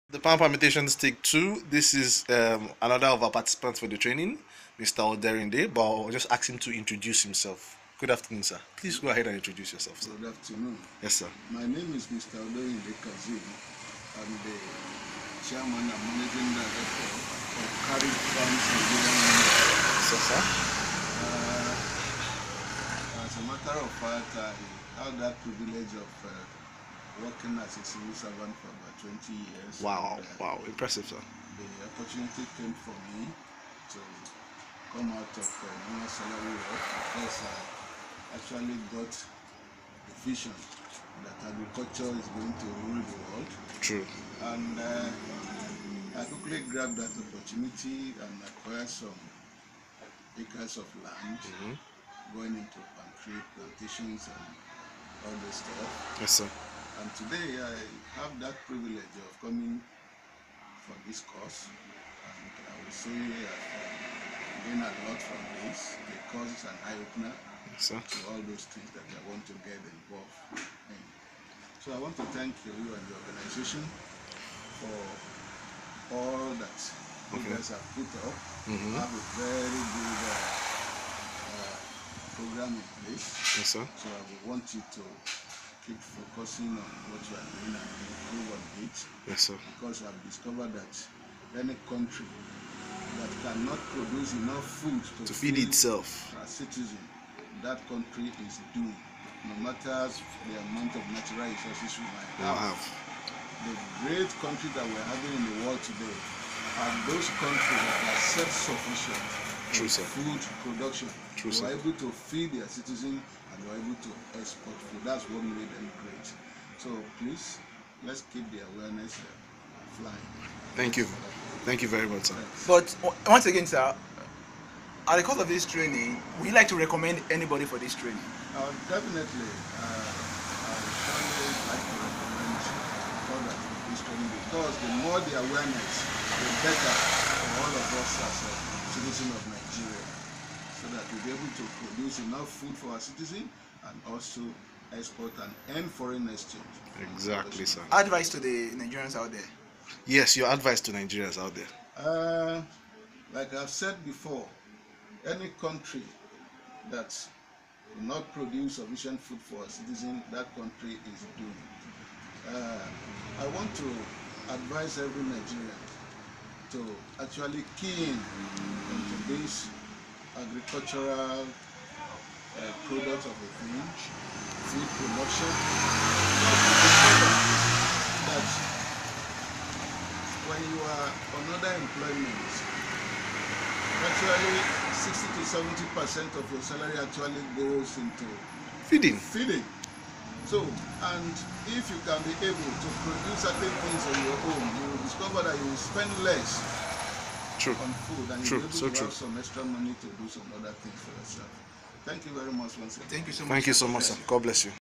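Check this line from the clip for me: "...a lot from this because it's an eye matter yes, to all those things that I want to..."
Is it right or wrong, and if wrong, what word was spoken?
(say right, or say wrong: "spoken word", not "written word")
wrong: "opener", not "matter".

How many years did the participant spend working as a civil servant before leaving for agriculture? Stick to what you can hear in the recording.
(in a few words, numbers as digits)
20.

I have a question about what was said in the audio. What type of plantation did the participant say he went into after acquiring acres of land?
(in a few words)
Palm plantations.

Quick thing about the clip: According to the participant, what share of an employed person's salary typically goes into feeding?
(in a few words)
60 to 70 percent.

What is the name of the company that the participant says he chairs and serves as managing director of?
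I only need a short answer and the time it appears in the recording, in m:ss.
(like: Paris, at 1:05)
Carib Farms, at 0:17.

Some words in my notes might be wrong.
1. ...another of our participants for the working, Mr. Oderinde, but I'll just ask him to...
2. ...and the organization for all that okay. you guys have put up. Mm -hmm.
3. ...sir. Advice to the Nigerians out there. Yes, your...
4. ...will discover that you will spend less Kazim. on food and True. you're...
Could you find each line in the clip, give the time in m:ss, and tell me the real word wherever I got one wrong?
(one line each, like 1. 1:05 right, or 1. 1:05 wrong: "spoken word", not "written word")
1. 0:02 wrong: "training", not "working"
2. 1:12 right
3. 2:27 right
4. 3:14 wrong: "True", not "Kazim".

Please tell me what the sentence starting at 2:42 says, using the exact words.
Uh, I want to advise every Nigerian to actually key in into this agricultural uh, of the village, food production.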